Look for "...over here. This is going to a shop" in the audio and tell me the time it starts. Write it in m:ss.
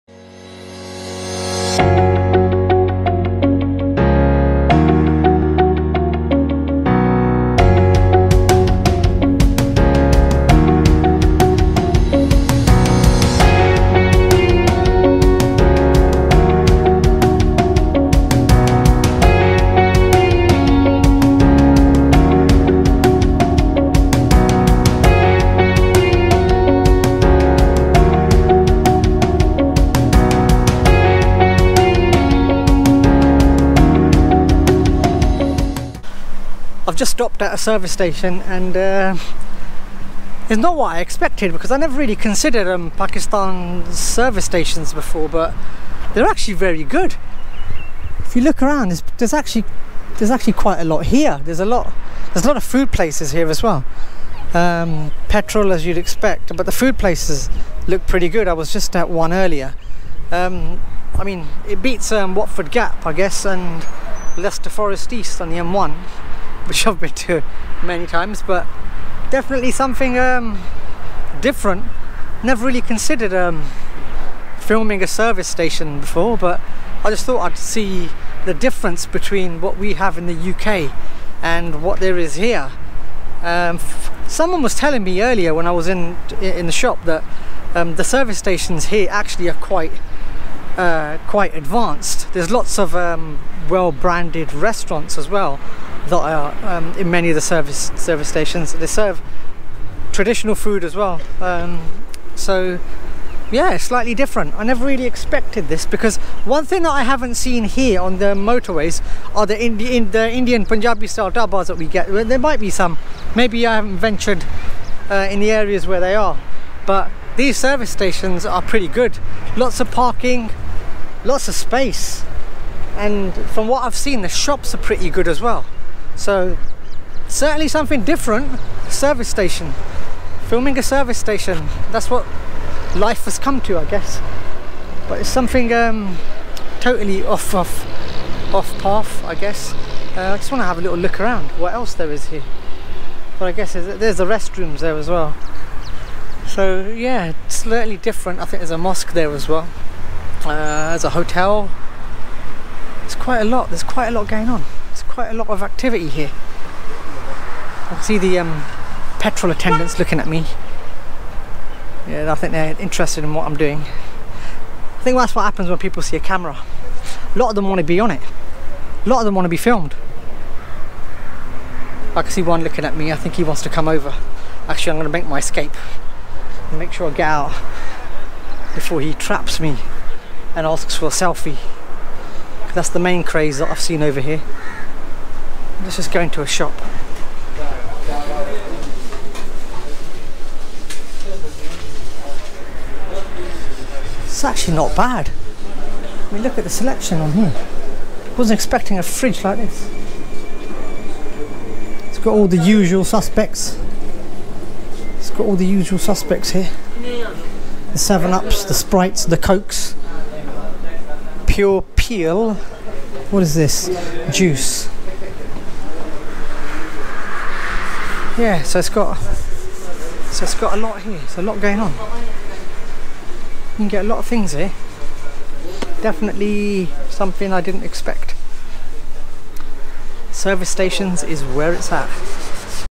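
3:04.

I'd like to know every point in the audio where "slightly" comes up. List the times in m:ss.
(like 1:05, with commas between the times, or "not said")
1:43, 2:27.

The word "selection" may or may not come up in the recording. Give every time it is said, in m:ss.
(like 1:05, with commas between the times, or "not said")
3:16.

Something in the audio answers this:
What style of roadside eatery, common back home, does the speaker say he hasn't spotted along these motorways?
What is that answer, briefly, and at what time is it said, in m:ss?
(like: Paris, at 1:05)
Punjabi style dhabas, at 1:50.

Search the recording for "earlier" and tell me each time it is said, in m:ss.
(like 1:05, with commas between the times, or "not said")
0:59, 1:25.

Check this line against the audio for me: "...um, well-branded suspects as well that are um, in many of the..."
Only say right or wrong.
wrong.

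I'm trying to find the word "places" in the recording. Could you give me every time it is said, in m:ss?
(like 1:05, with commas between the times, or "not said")
0:52, 0:56.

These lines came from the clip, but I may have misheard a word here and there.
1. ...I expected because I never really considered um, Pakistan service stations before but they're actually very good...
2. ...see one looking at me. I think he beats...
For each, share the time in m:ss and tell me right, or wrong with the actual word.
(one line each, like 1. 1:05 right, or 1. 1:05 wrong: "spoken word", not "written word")
1. 0:40 right
2. 2:52 wrong: "wants", not "beats".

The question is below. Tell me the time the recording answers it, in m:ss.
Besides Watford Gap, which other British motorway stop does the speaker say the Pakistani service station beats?
1:04.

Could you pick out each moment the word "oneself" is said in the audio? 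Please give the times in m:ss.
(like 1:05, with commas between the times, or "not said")
not said.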